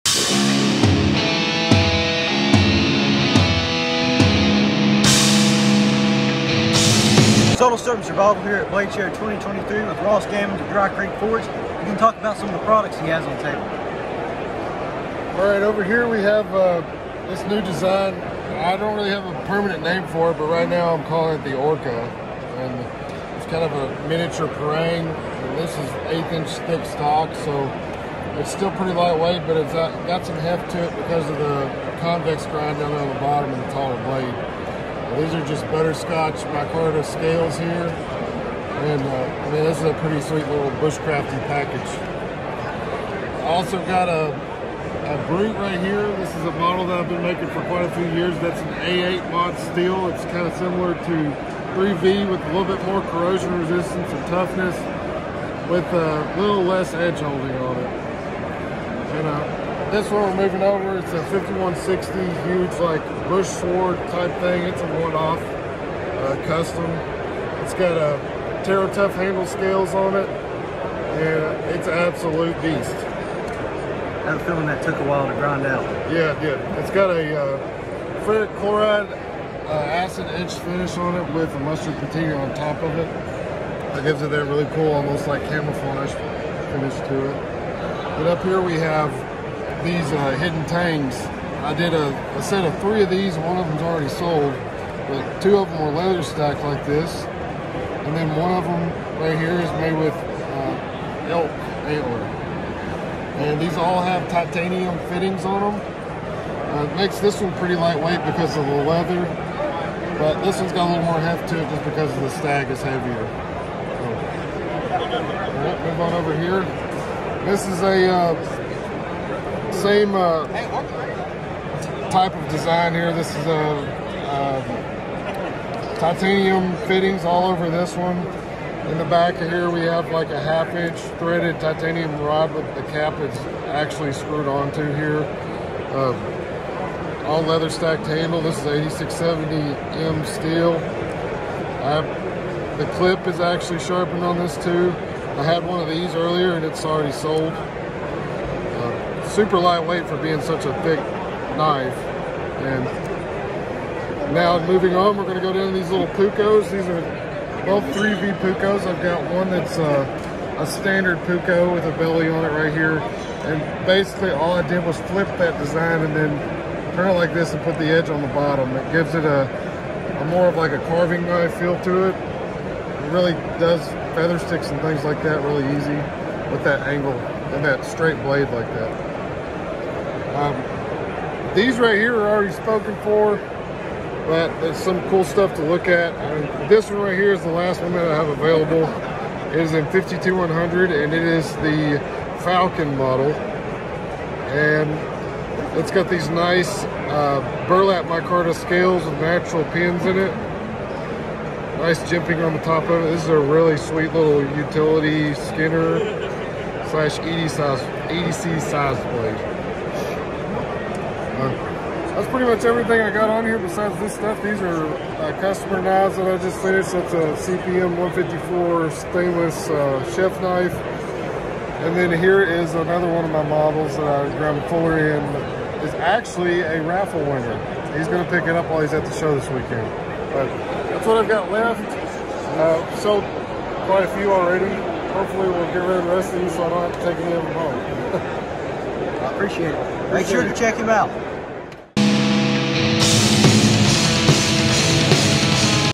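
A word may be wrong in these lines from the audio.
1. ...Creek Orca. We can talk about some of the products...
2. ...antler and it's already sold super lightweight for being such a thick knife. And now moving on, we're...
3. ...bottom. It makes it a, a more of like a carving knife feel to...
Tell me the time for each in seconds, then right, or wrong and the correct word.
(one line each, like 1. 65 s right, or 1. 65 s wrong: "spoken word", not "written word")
1. 10 s wrong: "Forge", not "Orca"
2. 146 s wrong: "earlier", not "antler"
3. 168 s wrong: "gives", not "makes".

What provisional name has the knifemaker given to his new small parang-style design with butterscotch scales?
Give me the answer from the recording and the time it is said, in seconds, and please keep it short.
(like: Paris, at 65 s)
Orca, at 21 s.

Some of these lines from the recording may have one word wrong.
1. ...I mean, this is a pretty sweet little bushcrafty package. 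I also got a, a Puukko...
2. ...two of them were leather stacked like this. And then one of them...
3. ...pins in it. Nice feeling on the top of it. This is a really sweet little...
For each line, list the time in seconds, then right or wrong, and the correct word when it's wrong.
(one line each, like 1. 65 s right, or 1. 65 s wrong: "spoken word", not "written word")
1. 39 s wrong: "Brute", not "Puukko"
2. 95 s right
3. 199 s wrong: "jimping", not "feeling".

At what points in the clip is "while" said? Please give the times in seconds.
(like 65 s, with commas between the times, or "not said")
75 s, 228 s.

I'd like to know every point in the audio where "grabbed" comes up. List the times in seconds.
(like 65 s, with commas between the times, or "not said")
224 s.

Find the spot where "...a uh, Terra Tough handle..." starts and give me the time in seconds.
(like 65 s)
67 s.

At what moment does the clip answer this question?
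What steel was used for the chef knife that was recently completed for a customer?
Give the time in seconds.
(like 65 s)
217 s.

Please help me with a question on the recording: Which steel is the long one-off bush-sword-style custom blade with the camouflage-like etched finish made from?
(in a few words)
5160.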